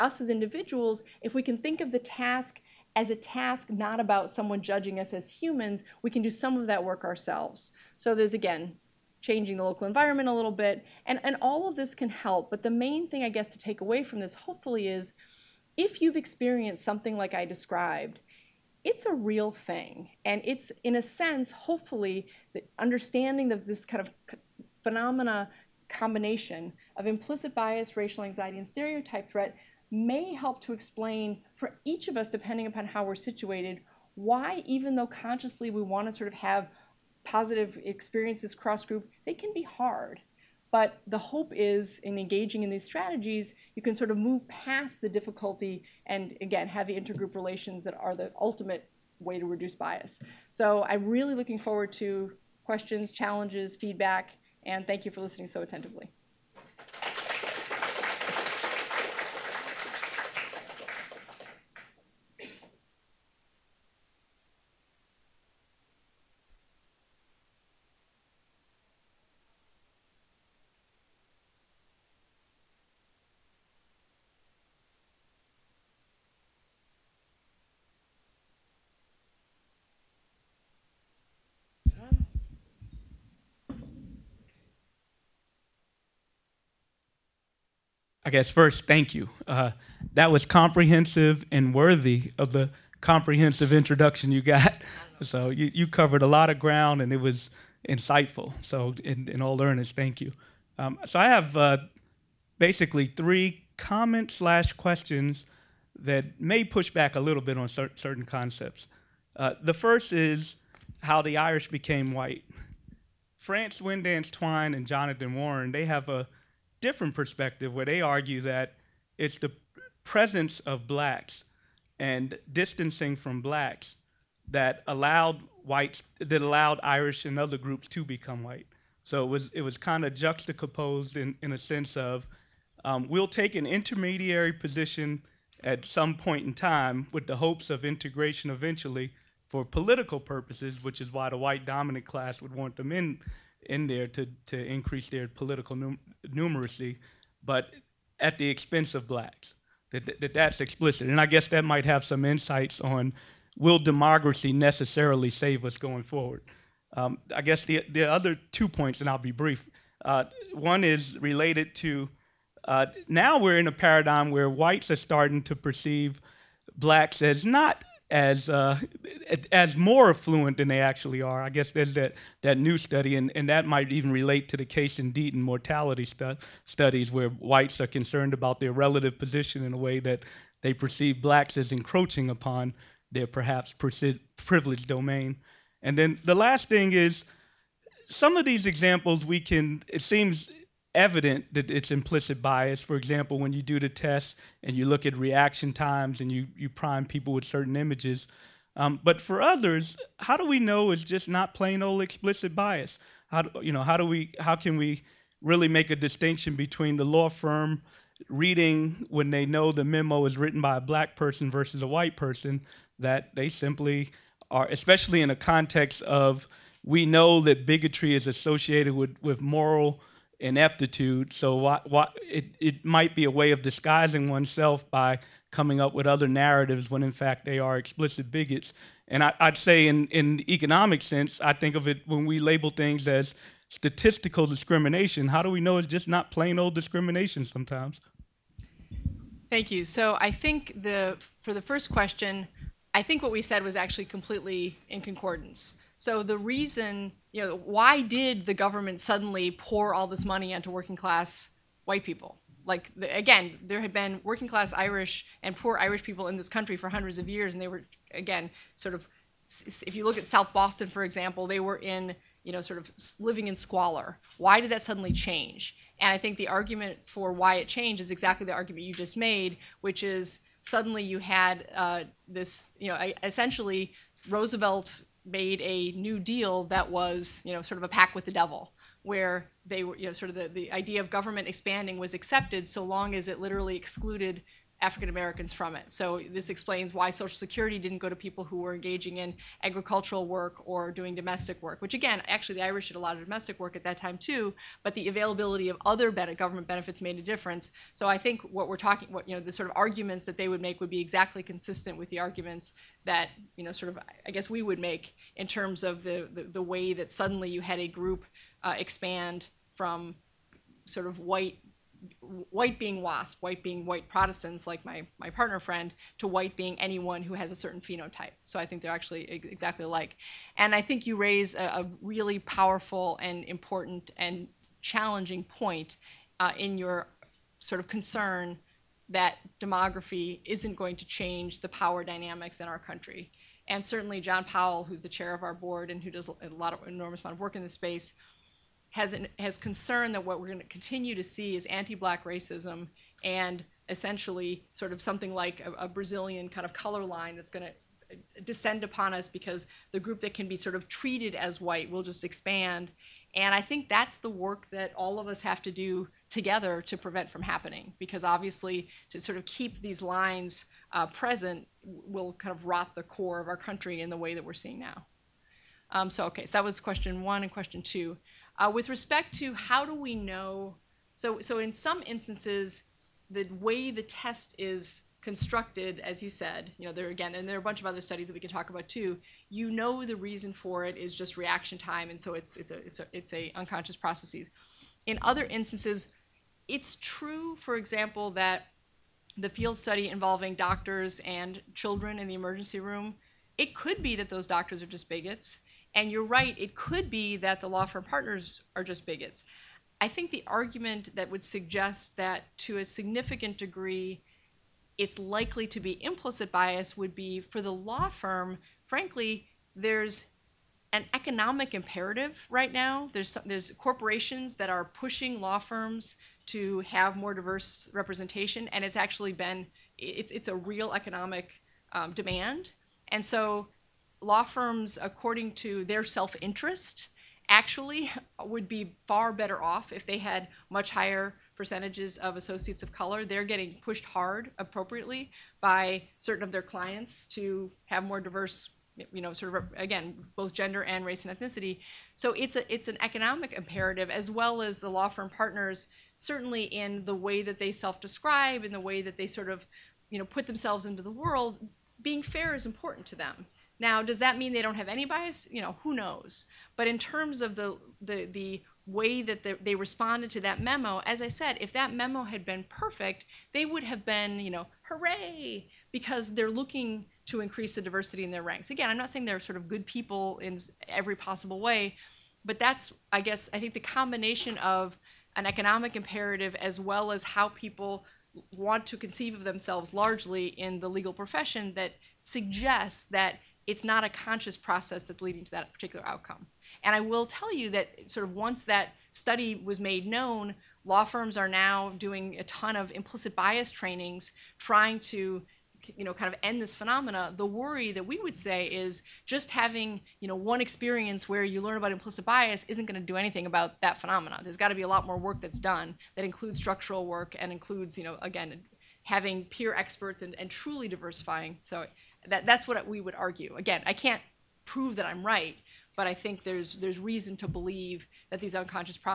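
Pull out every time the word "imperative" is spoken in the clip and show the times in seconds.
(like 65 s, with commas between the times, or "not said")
411 s, 443 s, 475 s.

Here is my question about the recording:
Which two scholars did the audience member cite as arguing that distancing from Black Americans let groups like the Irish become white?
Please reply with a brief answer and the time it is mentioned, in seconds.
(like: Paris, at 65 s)
France Winddance Twine and Jonathan Warren, at 113 s.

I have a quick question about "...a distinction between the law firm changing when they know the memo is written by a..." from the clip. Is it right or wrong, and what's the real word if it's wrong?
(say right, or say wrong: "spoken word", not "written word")
wrong: "reading", not "changing".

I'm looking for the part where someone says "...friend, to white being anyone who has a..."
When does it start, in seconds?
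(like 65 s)
315 s.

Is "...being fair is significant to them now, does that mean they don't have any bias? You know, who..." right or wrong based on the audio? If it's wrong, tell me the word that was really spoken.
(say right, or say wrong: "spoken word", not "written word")
wrong: "important", not "significant".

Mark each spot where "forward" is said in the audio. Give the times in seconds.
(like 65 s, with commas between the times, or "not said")
51 s, 156 s.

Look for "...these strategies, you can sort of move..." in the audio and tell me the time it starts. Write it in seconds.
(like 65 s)
42 s.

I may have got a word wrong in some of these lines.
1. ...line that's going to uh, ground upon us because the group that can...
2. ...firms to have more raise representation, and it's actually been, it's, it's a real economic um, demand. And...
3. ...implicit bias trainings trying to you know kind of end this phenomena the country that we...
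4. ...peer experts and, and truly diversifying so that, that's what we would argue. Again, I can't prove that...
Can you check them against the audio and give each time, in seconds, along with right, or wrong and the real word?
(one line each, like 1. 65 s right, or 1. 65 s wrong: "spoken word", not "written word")
1. 347 s wrong: "descend", not "ground"
2. 415 s wrong: "diverse", not "raise"
3. 492 s wrong: "worry", not "country"
4. 509 s right.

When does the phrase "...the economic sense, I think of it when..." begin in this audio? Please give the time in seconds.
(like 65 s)
230 s.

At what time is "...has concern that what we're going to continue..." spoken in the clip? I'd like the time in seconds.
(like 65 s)
339 s.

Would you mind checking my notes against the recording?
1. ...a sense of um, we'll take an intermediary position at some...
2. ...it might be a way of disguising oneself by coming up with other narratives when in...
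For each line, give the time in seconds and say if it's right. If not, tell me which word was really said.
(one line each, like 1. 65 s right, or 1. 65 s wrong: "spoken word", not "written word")
1. 131 s right
2. 222 s right.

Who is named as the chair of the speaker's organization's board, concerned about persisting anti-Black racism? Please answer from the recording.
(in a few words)
John Powell.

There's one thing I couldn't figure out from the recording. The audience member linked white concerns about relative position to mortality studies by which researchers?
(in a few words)
Case and Deaton.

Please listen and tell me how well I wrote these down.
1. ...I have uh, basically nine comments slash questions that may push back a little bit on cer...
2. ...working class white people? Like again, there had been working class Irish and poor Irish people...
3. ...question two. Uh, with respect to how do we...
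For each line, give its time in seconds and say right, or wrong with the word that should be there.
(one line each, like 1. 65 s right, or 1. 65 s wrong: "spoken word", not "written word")
1. 101 s wrong: "three", not "nine"
2. 250 s right
3. 367 s right.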